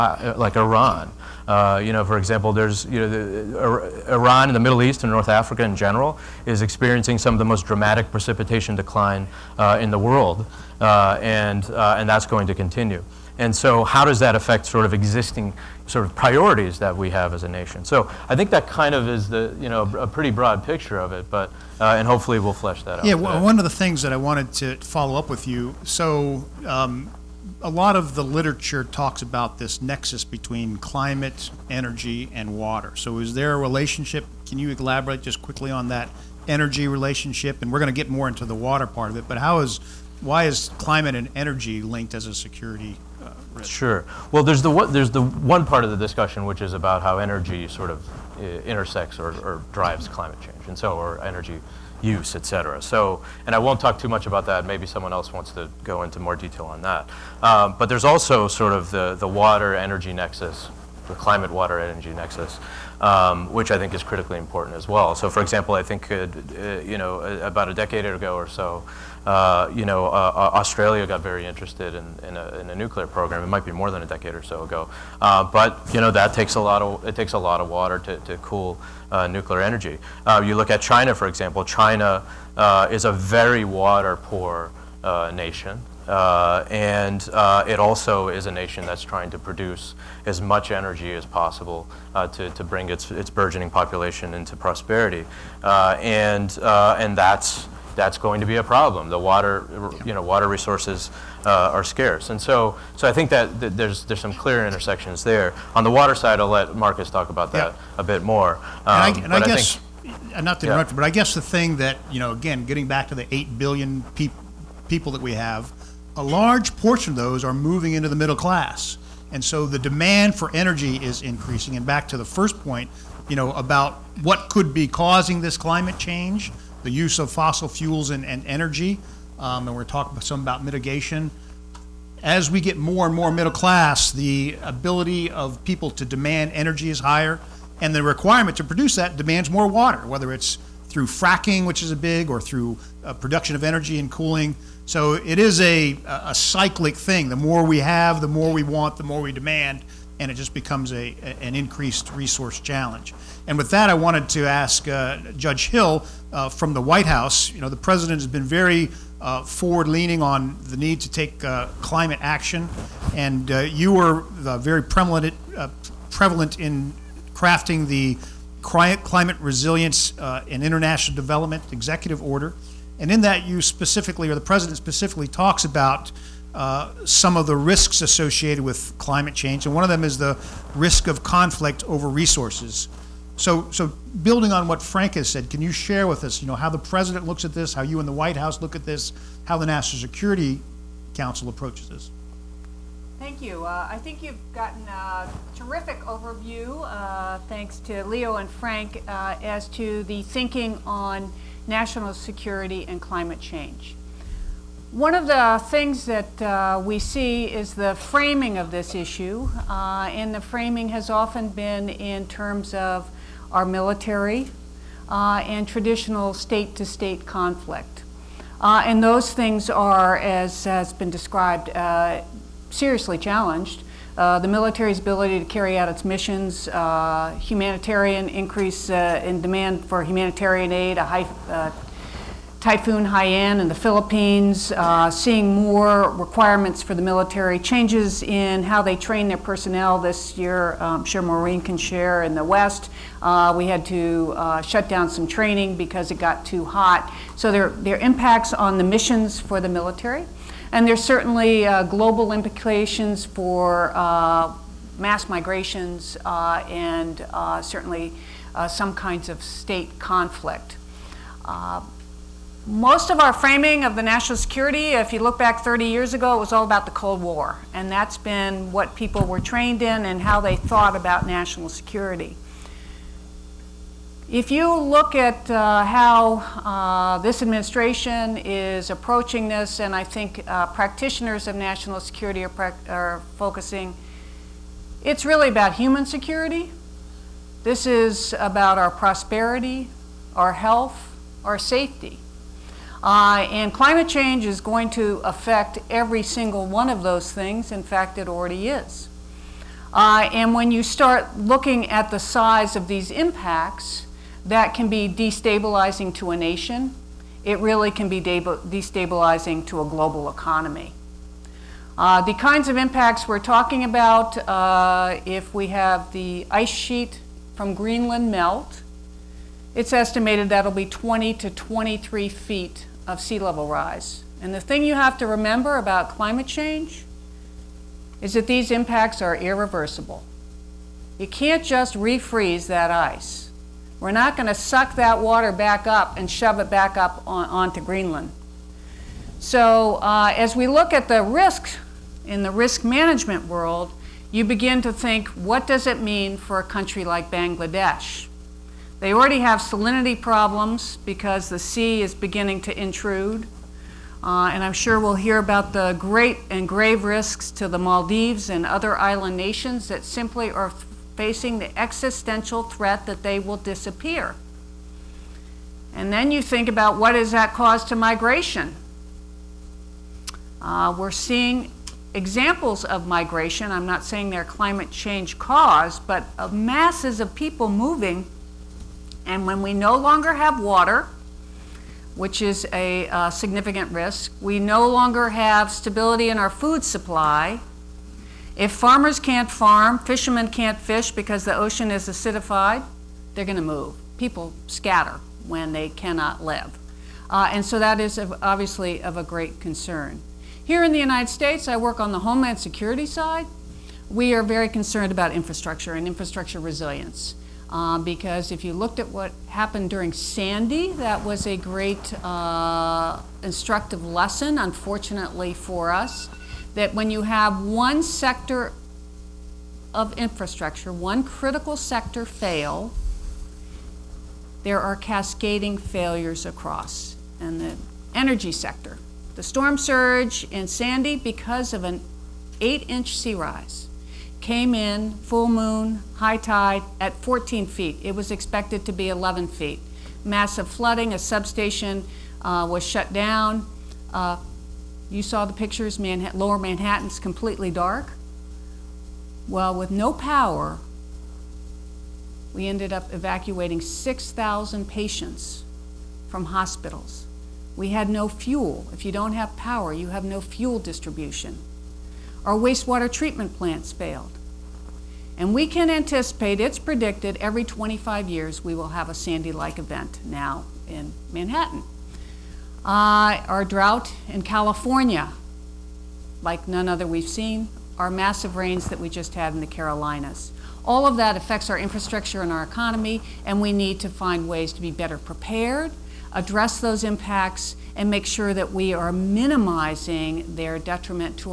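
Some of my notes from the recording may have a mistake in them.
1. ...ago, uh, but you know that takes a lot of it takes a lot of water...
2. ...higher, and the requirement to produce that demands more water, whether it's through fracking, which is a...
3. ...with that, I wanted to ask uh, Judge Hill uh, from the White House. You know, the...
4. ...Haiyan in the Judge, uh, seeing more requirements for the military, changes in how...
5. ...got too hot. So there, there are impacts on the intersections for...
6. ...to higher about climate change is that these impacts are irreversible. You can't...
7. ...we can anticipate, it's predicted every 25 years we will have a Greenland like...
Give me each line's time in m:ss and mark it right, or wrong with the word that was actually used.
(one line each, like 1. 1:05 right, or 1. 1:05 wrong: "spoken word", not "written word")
1. 1:14 right
2. 2:16 right
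3. 2:33 right
4. 3:53 wrong: "Philippines", not "Judge"
5. 4:06 wrong: "missions", not "intersections"
6. 5:25 wrong: "remember", not "higher"
7. 7:45 wrong: "Sandy", not "Greenland".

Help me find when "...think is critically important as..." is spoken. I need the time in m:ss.
1:03.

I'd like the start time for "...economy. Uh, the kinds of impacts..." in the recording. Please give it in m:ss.
5:10.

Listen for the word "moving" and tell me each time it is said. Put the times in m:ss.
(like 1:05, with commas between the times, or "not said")
1:57, 6:17.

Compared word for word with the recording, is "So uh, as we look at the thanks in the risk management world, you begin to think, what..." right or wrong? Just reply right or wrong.
wrong.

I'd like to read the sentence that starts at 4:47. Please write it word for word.
This is about our prosperity, our health, our safety.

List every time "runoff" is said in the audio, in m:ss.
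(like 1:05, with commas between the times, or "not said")
not said.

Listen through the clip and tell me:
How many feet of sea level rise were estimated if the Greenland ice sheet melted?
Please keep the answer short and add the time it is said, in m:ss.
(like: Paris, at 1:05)
20 to 23 feet, at 5:20.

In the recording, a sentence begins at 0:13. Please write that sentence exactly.
And so how does that affect sort of existing sort of priorities that we have as a nation?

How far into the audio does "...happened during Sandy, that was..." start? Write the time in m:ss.
6:49.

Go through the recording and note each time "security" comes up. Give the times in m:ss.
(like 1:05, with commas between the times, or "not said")
0:42, 3:09, 3:22, 4:24, 4:31, 4:41, 4:46, 6:42.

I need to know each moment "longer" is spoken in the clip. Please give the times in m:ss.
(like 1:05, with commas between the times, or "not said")
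6:19, 6:24.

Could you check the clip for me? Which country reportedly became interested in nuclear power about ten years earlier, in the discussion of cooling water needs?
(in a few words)
Australia.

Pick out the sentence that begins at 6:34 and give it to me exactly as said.
People scatter when they cannot live.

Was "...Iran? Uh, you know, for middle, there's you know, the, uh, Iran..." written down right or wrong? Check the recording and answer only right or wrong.
wrong.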